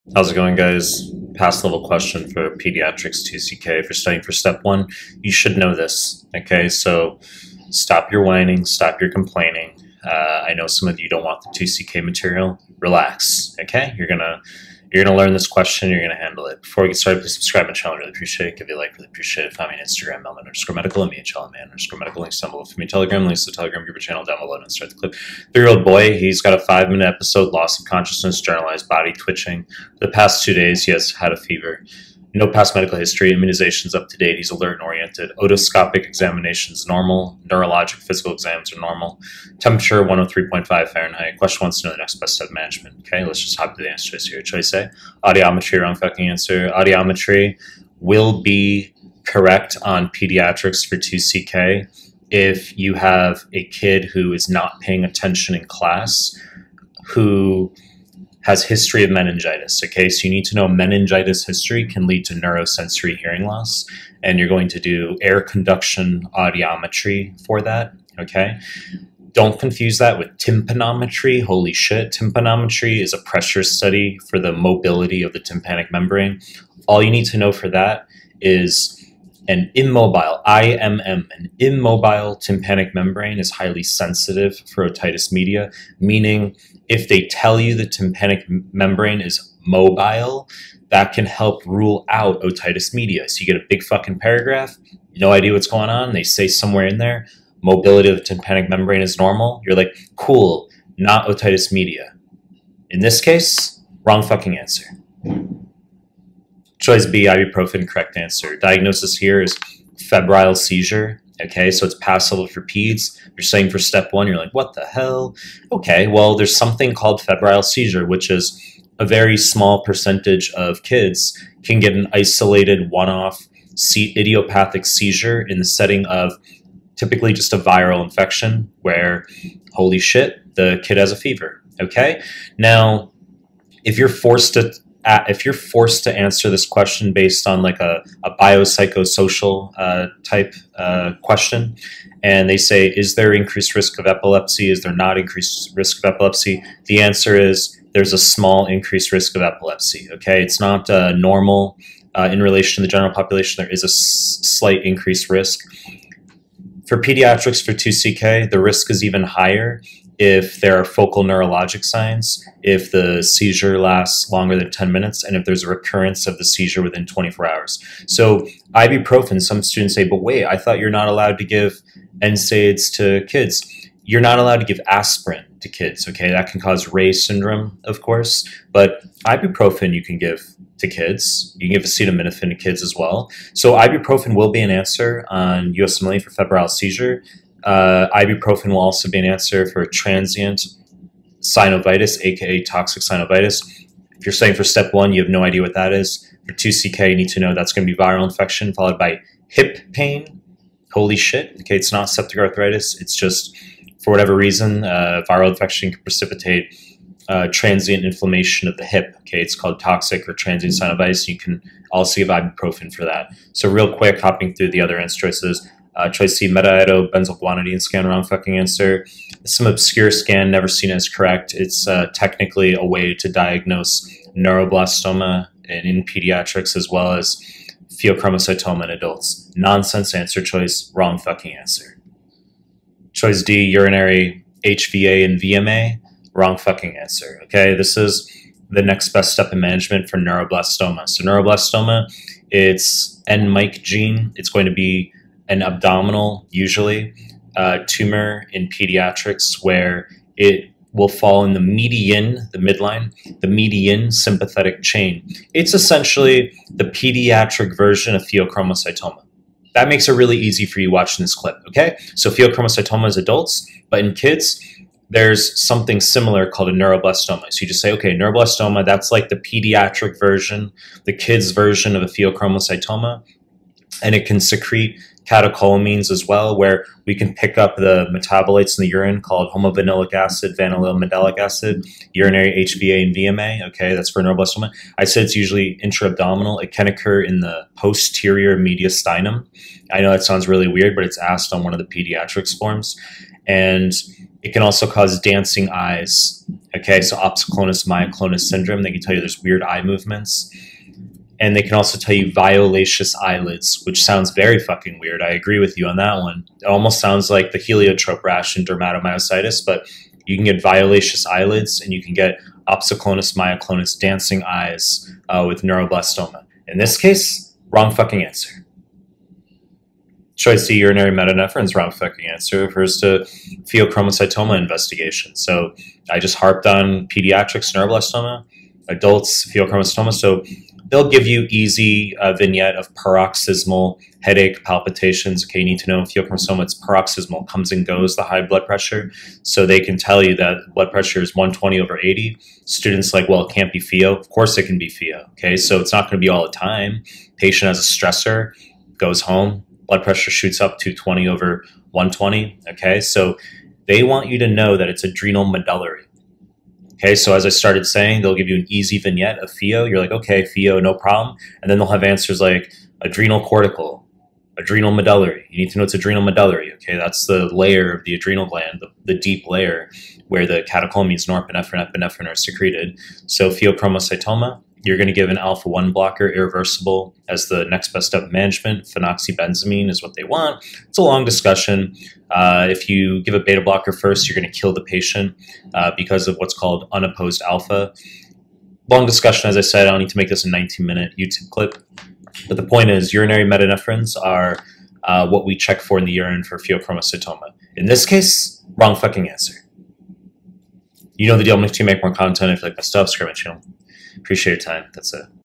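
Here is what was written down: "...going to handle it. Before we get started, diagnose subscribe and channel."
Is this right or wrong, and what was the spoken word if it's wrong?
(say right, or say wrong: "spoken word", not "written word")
wrong: "please", not "diagnose".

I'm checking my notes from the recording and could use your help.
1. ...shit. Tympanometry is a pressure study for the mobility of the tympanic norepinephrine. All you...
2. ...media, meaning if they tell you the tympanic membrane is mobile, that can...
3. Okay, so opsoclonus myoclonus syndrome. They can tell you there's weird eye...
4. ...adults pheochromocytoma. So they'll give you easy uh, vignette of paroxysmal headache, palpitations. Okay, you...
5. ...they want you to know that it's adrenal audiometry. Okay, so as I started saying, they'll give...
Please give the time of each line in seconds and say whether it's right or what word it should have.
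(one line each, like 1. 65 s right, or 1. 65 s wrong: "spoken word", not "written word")
1. 71 s wrong: "membrane", not "norepinephrine"
2. 85 s right
3. 296 s right
4. 328 s right
5. 353 s wrong: "medullary", not "audiometry".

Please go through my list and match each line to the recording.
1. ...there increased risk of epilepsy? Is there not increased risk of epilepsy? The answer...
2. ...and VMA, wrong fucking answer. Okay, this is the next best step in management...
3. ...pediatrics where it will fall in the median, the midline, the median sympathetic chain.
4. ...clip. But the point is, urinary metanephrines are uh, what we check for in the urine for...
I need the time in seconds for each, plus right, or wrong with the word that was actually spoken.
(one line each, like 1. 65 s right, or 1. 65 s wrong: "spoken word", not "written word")
1. 143 s right
2. 235 s right
3. 248 s right
4. 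391 s right.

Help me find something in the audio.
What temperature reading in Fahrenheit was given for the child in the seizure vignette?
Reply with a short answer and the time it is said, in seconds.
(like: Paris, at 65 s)
103.5, at 40 s.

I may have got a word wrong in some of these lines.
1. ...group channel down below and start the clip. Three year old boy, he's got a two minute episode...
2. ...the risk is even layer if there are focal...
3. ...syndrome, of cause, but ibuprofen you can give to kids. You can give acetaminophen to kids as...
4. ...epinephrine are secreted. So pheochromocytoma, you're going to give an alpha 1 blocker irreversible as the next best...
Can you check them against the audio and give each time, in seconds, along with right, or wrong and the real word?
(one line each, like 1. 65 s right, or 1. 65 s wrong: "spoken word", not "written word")
1. 23 s wrong: "five", not "two"
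2. 158 s wrong: "higher", not "layer"
3. 177 s wrong: "course", not "cause"
4. 371 s right.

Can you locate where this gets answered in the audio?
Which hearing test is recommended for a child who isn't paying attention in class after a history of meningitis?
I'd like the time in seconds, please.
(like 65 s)
65 s.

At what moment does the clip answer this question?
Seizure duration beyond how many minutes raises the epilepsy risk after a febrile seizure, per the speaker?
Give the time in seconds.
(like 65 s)
164 s.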